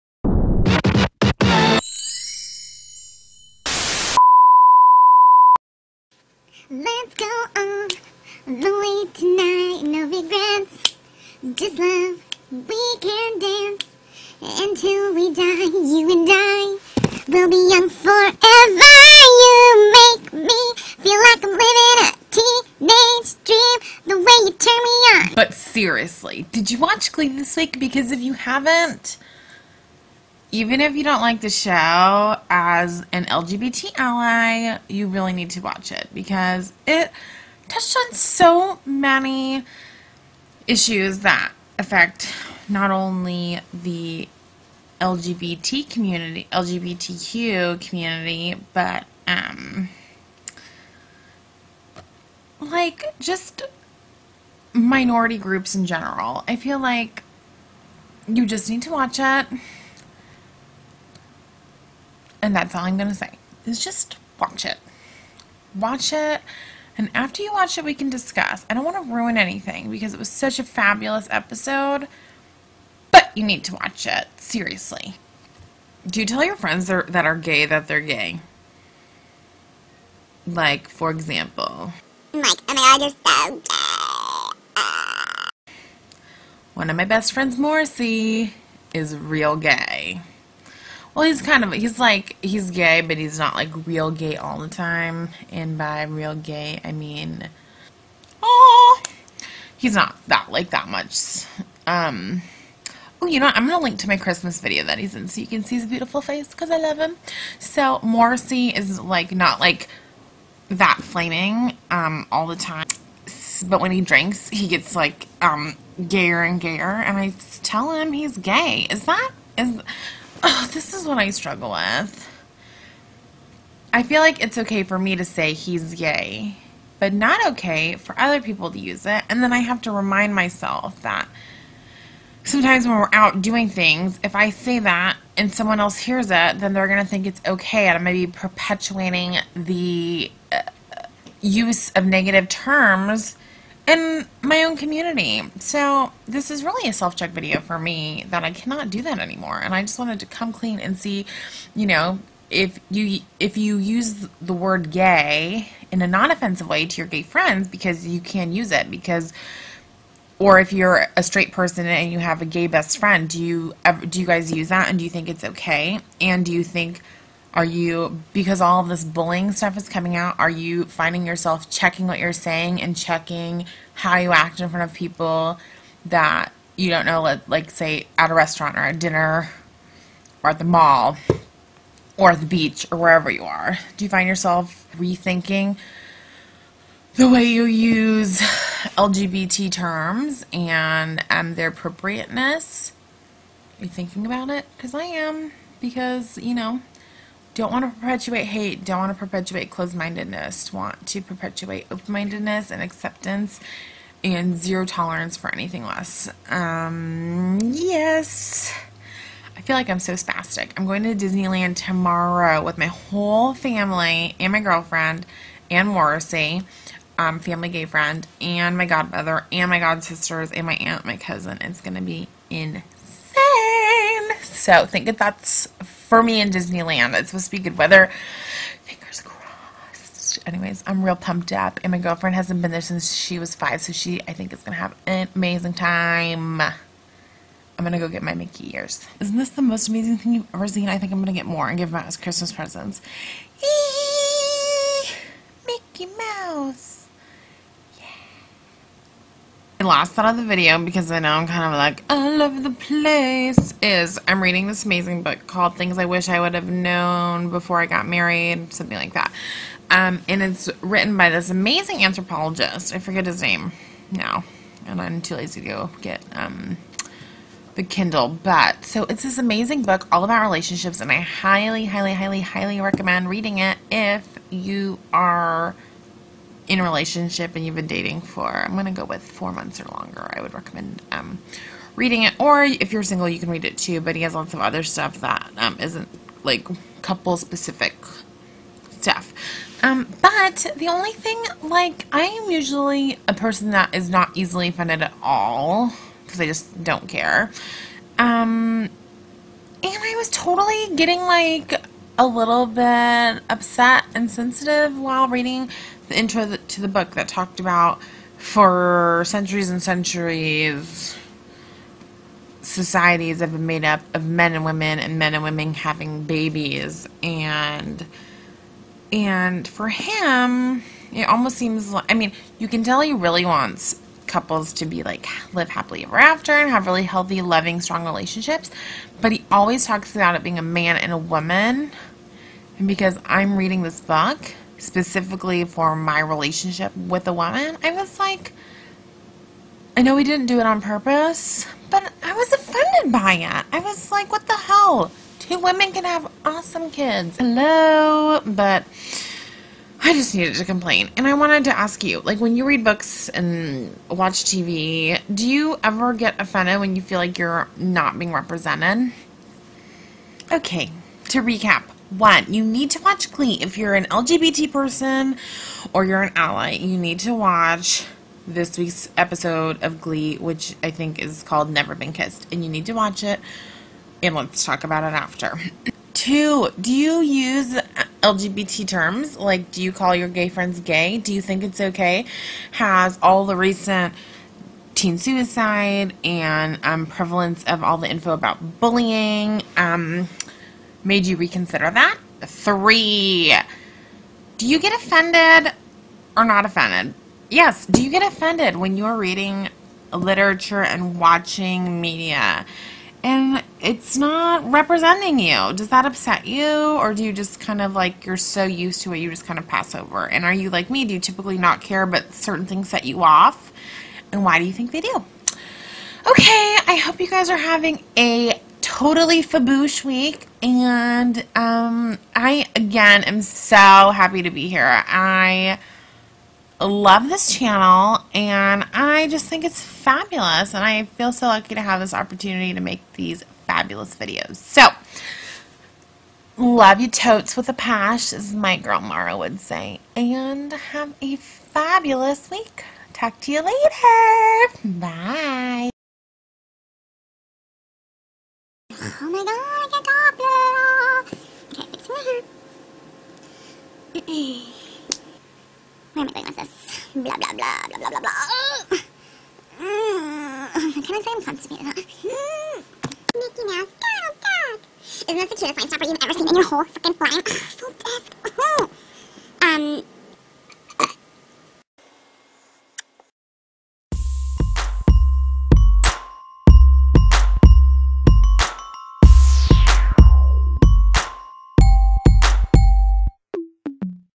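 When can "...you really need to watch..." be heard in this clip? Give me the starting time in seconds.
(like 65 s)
34 s.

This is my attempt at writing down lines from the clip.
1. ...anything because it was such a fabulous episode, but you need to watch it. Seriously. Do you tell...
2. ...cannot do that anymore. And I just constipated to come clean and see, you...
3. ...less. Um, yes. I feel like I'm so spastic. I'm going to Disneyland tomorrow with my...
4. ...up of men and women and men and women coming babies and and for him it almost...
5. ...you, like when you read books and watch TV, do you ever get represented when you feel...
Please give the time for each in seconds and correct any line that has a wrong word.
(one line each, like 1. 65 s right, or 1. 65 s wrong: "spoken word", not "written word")
1. 69 s right
2. 148 s wrong: "wanted", not "constipated"
3. 205 s right
4. 313 s wrong: "having", not "coming"
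5. 352 s wrong: "offended", not "represented".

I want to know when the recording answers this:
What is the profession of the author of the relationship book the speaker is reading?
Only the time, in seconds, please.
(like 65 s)
262 s.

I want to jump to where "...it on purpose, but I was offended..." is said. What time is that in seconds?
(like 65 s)
340 s.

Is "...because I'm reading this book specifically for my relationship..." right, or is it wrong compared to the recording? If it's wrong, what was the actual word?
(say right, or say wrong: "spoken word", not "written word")
right.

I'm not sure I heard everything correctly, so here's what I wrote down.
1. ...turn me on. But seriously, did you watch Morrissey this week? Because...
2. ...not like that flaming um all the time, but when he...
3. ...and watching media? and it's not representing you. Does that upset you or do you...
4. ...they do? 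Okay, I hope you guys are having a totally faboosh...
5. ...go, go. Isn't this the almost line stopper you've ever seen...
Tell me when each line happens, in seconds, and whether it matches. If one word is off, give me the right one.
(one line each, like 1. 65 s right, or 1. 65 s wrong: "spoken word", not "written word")
1. 24 s wrong: "Glee", not "Morrissey"
2. 109 s right
3. 400 s right
4. 414 s right
5. 464 s wrong: "cutest", not "almost".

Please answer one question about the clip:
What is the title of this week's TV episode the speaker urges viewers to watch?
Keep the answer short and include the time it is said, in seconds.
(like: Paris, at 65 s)
Never Been Kissed, at 371 s.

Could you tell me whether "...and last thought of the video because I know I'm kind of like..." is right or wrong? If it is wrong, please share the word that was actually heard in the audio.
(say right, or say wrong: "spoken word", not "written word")
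right.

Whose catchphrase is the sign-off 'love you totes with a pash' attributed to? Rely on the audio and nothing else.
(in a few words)
Mara.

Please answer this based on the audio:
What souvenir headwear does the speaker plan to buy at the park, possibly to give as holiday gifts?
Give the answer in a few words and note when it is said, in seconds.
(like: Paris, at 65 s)
Mickey ears, at 238 s.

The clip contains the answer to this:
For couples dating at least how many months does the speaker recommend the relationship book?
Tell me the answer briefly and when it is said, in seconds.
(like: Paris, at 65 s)
4 months, at 279 s.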